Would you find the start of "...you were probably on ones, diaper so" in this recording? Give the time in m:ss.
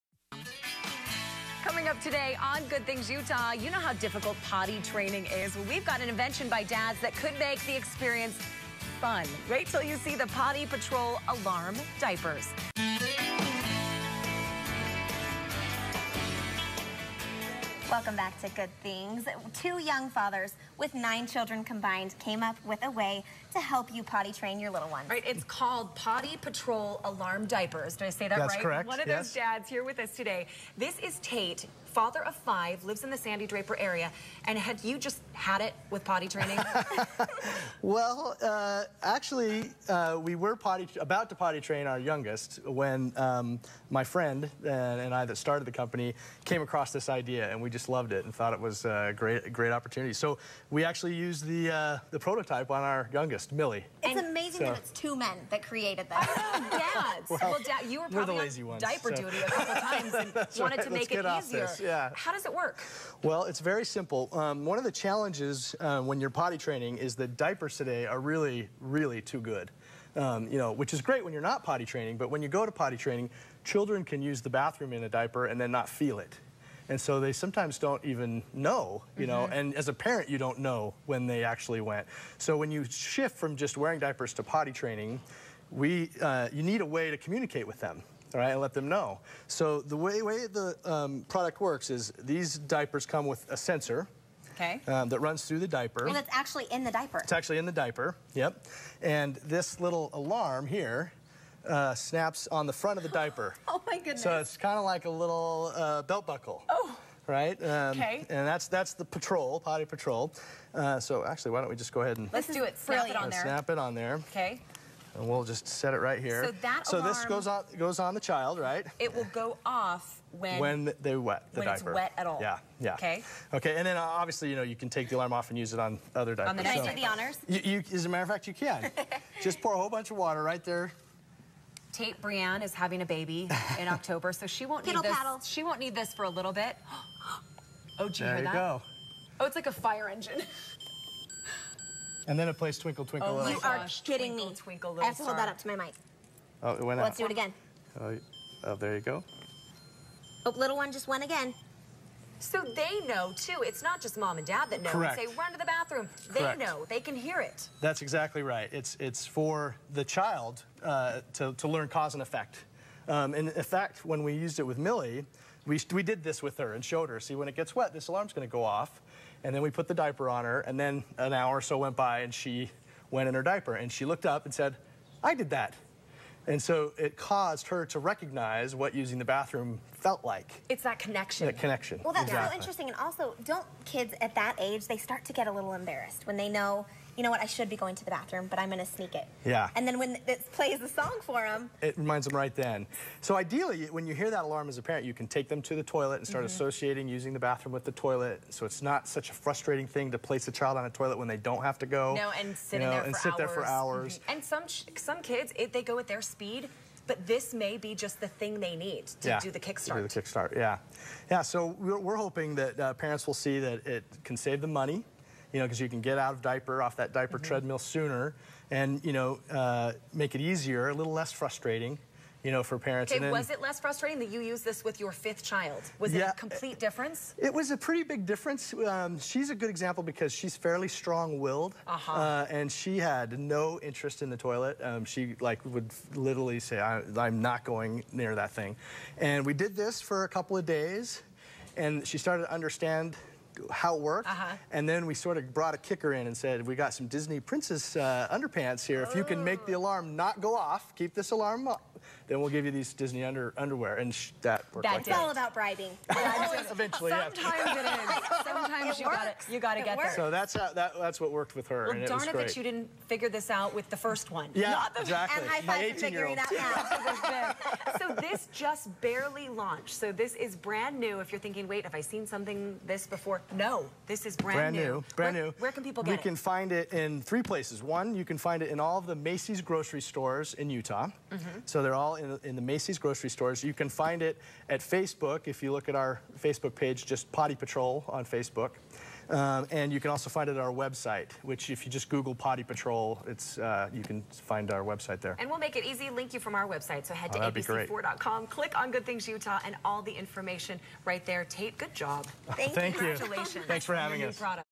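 0:57.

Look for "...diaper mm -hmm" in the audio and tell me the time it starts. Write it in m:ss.
3:37.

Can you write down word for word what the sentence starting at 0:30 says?
This is Tate, father of five, lives in the Sandy Draper area.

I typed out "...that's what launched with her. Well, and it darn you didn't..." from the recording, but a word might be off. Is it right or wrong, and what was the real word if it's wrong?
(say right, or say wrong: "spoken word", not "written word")
wrong: "worked", not "launched".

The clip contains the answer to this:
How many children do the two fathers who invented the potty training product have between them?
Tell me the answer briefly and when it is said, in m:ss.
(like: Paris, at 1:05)
9, at 0:20.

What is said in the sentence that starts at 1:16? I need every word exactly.
And so they sometimes don't even know, you know, mm -hmm.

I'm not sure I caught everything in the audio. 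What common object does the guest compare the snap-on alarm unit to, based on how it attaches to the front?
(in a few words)
Belt buckle.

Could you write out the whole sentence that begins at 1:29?
So the way, way the um, product works is these diapers come with a sensor okay.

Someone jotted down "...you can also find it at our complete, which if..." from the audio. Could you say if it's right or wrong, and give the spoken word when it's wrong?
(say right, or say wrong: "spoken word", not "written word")
wrong: "website", not "complete".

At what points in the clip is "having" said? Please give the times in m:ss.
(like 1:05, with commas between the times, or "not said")
2:12, 5:03.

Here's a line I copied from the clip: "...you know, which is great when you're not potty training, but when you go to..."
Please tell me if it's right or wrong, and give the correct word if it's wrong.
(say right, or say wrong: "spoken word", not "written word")
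right.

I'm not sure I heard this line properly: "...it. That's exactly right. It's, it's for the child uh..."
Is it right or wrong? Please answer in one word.
right.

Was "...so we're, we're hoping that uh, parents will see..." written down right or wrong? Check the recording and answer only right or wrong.
right.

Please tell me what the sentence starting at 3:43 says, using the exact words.
Okay, then, was it less frustrating that you used this with your fifth child?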